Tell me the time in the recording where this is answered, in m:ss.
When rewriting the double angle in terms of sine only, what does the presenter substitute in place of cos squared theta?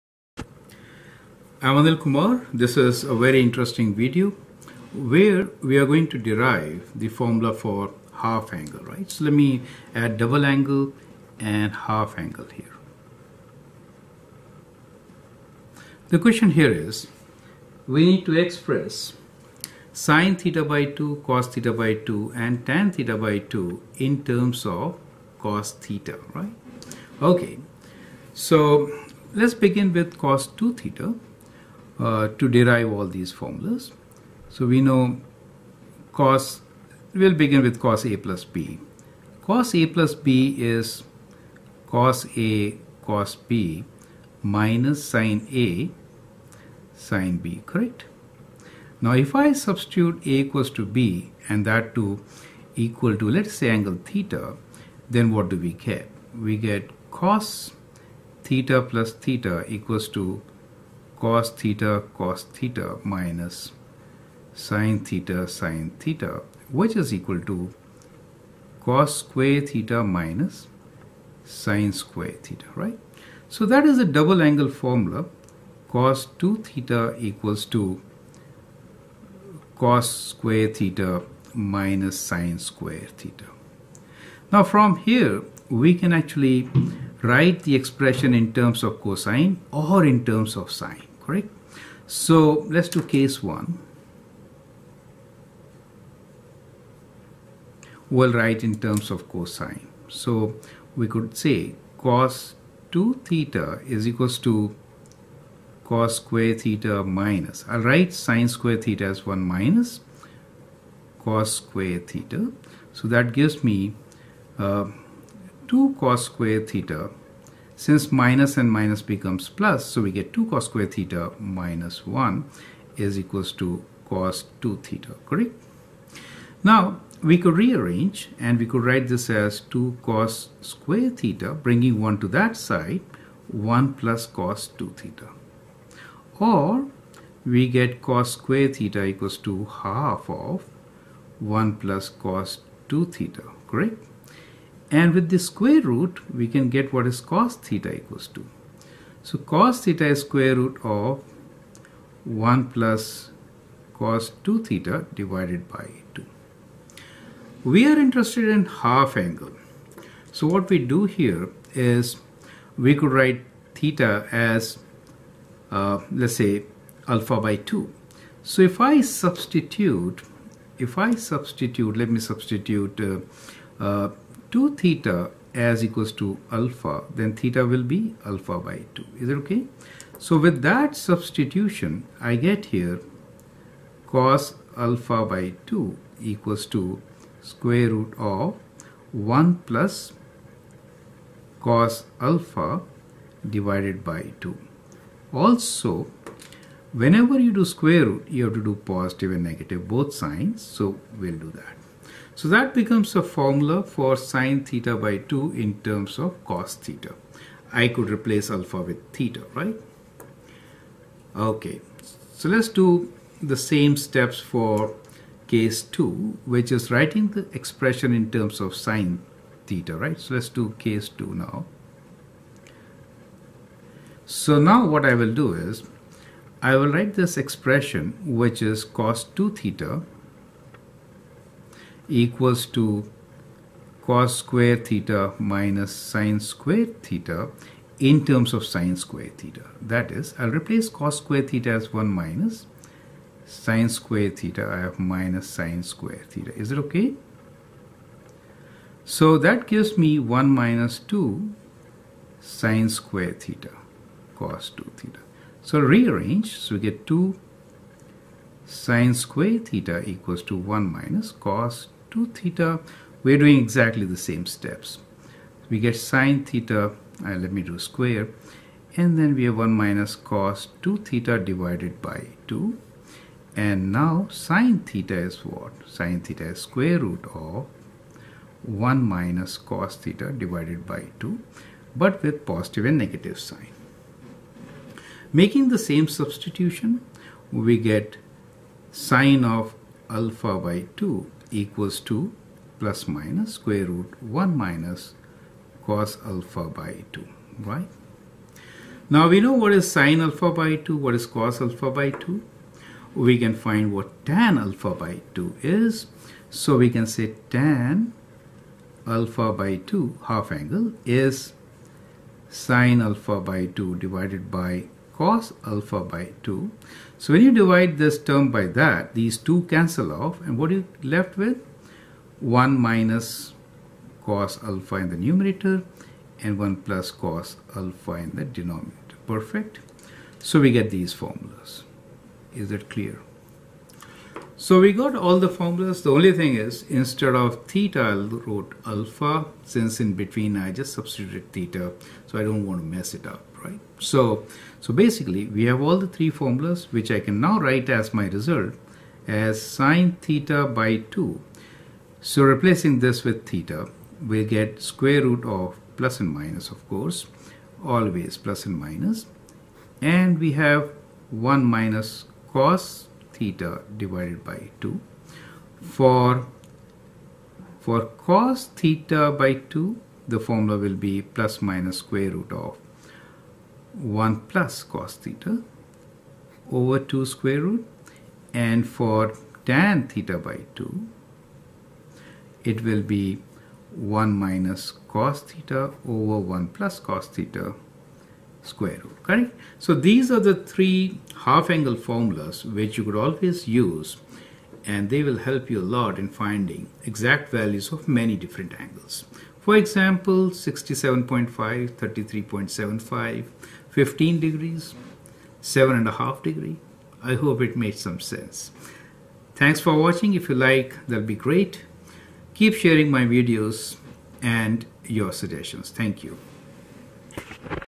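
4:01.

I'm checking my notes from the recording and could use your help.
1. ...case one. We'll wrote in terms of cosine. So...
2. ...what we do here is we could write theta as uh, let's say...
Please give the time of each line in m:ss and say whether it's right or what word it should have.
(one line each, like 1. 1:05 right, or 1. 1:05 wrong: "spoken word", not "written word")
1. 1:33 wrong: "write", not "wrote"
2. 2:40 right.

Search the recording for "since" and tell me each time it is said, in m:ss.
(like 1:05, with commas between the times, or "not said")
1:57, 5:39.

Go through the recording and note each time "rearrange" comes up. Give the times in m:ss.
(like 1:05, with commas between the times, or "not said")
2:07, 4:15.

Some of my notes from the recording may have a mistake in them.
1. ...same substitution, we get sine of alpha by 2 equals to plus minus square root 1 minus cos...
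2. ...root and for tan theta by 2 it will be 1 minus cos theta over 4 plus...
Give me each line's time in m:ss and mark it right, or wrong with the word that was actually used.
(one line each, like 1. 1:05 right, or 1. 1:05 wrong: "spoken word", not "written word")
1. 4:45 right
2. 6:17 wrong: "1", not "4".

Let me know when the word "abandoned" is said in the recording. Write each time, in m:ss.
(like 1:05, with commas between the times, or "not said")
not said.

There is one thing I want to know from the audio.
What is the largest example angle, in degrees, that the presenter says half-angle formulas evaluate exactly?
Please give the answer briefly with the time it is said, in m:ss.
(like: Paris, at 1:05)
67.5, at 6:40.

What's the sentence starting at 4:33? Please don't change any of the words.
And now sine theta is what?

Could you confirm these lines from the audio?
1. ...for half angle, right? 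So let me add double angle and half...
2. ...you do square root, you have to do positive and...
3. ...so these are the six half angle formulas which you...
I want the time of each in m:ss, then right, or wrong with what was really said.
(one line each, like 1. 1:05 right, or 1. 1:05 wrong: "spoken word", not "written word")
1. 0:07 right
2. 3:17 right
3. 6:29 wrong: "three", not "six".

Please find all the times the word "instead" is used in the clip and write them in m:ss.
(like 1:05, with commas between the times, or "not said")
5:37.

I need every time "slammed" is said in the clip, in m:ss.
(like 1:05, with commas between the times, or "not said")
not said.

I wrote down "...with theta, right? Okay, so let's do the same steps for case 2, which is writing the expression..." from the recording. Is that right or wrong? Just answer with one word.
right.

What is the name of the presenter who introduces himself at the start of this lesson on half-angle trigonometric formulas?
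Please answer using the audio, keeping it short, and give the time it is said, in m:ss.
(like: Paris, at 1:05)
Anil Kumar, at 0:01.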